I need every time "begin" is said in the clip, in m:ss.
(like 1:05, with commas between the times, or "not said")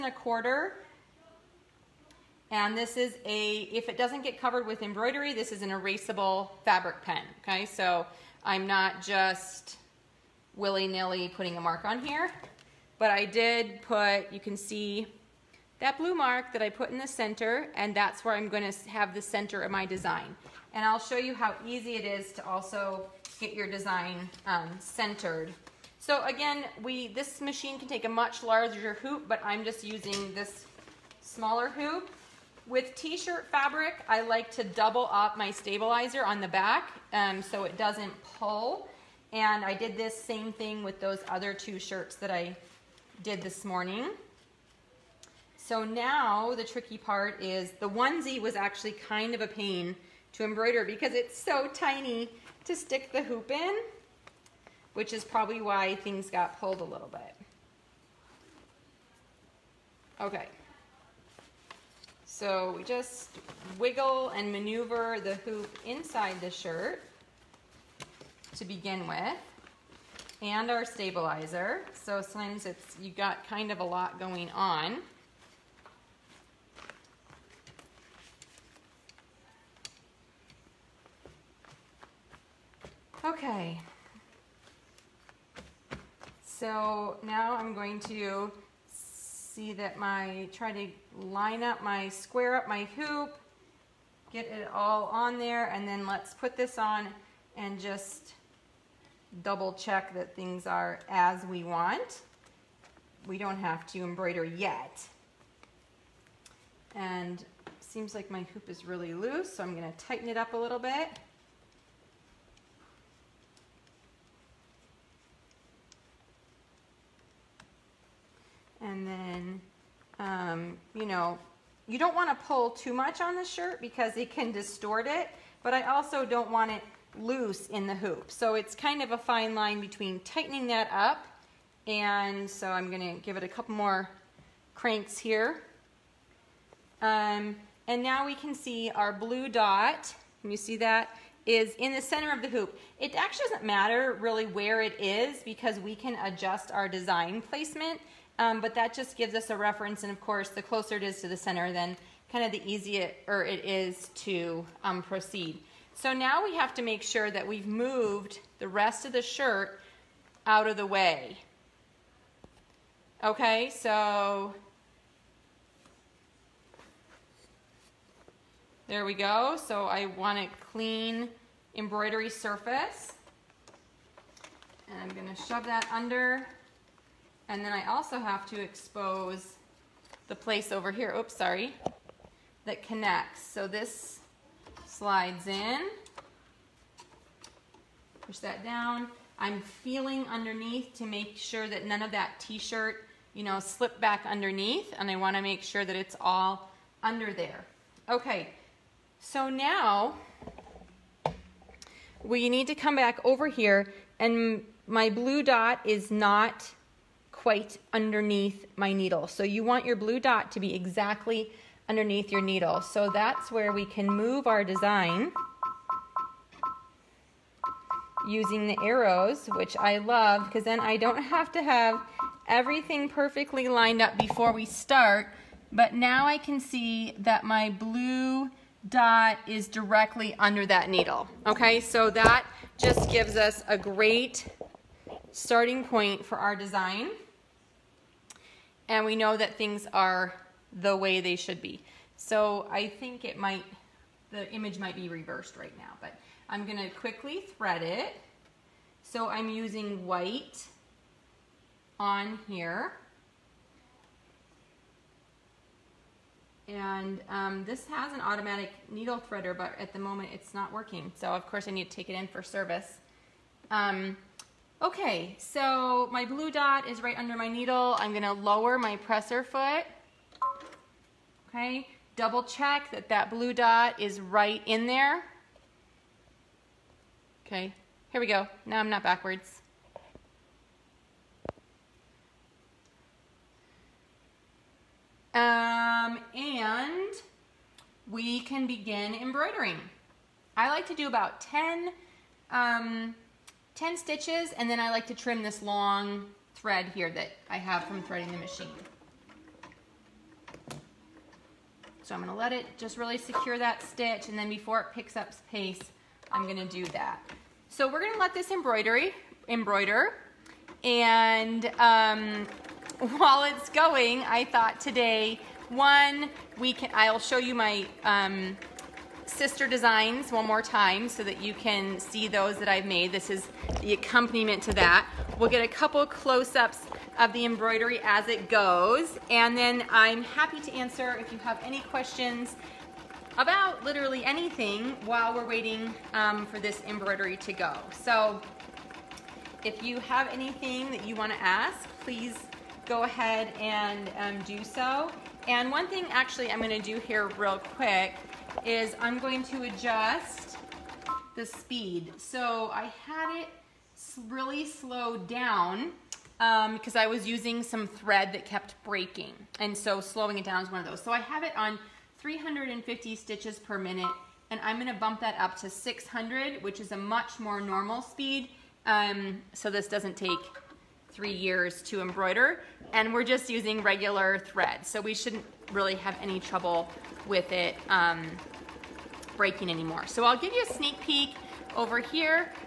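1:08, 4:48.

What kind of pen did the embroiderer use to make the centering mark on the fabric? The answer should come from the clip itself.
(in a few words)
erasable fabric pen.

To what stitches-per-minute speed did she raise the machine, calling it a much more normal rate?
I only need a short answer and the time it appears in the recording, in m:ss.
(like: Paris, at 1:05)
600, at 6:05.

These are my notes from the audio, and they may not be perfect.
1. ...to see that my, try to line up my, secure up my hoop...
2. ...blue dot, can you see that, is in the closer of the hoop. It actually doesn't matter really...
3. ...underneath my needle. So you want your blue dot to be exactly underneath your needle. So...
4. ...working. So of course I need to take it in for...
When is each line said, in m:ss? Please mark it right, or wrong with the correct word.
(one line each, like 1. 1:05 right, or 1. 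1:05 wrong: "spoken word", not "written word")
1. 1:27 wrong: "square", not "secure"
2. 2:19 wrong: "center", not "closer"
3. 3:27 right
4. 4:20 right.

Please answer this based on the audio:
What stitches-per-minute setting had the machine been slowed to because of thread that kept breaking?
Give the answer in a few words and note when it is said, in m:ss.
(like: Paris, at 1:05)
350, at 6:02.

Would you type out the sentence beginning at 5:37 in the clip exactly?
So if you have anything that you wanna ask, please go ahead and um, do so.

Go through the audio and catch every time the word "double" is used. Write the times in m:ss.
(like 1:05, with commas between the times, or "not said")
0:34, 1:39, 4:32.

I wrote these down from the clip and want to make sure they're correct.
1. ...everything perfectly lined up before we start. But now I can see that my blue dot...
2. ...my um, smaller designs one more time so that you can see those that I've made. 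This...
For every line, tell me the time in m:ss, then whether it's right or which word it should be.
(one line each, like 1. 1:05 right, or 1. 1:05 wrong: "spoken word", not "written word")
1. 3:42 right
2. 5:17 wrong: "sister", not "smaller".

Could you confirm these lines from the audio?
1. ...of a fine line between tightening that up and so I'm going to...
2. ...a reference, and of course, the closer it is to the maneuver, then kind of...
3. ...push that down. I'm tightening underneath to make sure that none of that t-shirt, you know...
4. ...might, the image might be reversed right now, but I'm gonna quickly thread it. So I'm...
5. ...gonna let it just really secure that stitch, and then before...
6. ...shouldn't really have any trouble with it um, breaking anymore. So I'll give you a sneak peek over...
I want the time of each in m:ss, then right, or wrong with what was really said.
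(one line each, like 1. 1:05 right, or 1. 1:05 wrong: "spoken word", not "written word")
1. 2:09 right
2. 2:29 wrong: "center", not "maneuver"
3. 3:08 wrong: "feeling", not "tightening"
4. 4:03 right
5. 5:02 right
6. 6:15 right.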